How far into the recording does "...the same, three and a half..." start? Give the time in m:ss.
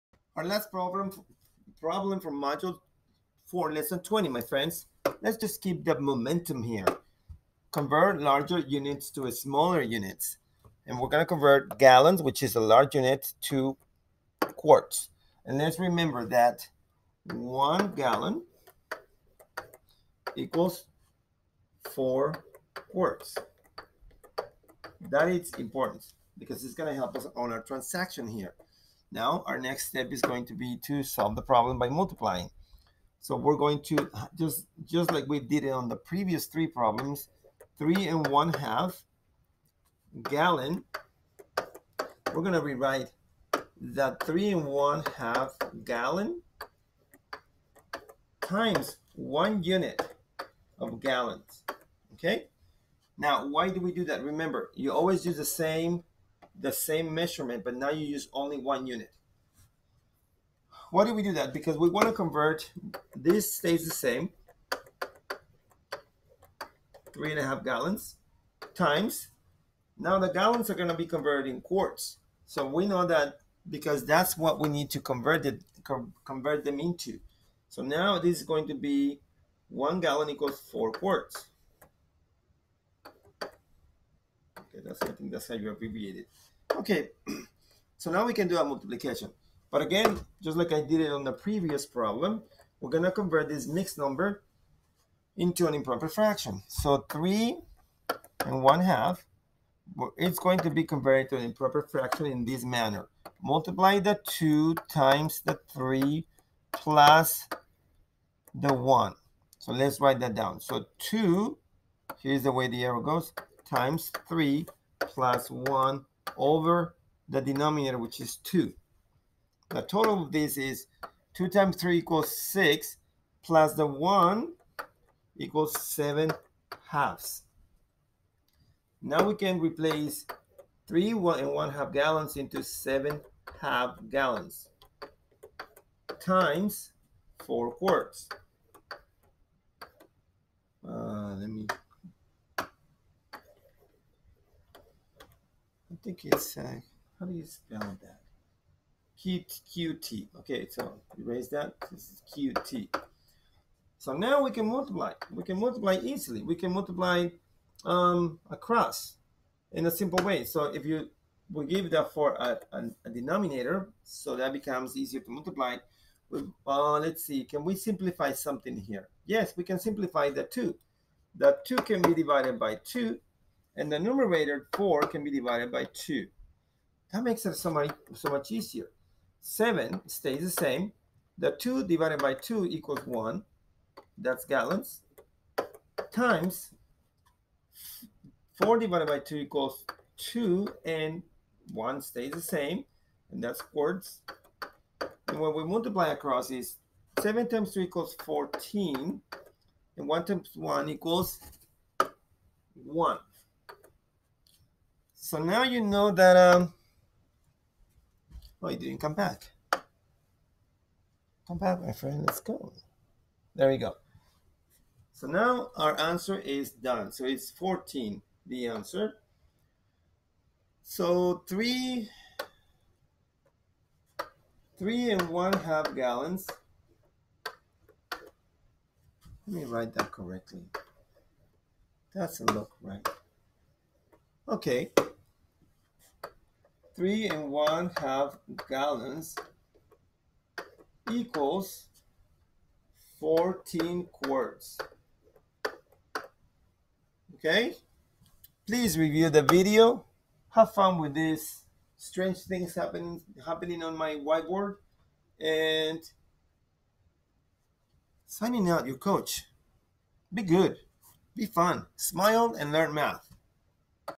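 1:03.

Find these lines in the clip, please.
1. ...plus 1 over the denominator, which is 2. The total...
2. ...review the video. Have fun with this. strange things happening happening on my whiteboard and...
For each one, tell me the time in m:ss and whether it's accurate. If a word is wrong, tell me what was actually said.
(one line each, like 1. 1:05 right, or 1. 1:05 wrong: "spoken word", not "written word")
1. 1:54 right
2. 4:08 right.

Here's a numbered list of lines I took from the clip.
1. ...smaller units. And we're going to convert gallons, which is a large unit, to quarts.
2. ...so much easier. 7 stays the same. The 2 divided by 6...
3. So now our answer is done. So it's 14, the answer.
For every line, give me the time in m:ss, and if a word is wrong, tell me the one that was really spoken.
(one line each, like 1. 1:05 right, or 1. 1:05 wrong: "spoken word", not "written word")
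1. 0:09 right
2. 2:58 wrong: "2", not "6"
3. 3:35 right.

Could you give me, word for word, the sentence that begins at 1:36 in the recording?
So three and one half, it's going to be converted to an improper fraction in this manner.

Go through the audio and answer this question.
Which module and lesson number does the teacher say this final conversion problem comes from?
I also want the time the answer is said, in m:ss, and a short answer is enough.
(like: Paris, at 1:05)
Module 4, lesson 20, at 0:02.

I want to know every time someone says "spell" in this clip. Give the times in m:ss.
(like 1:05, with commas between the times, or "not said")
2:27.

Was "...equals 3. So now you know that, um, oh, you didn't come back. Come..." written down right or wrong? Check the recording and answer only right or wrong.
wrong.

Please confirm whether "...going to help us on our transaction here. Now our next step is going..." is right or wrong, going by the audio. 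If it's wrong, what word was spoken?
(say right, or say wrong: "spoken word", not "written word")
right.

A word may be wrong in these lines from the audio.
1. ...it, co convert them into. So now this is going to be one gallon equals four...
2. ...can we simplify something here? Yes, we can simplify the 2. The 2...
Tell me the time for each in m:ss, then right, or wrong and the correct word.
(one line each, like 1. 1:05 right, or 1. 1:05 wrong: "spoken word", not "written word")
1. 1:15 right
2. 2:47 right.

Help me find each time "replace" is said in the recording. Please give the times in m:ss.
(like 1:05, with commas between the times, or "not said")
2:09.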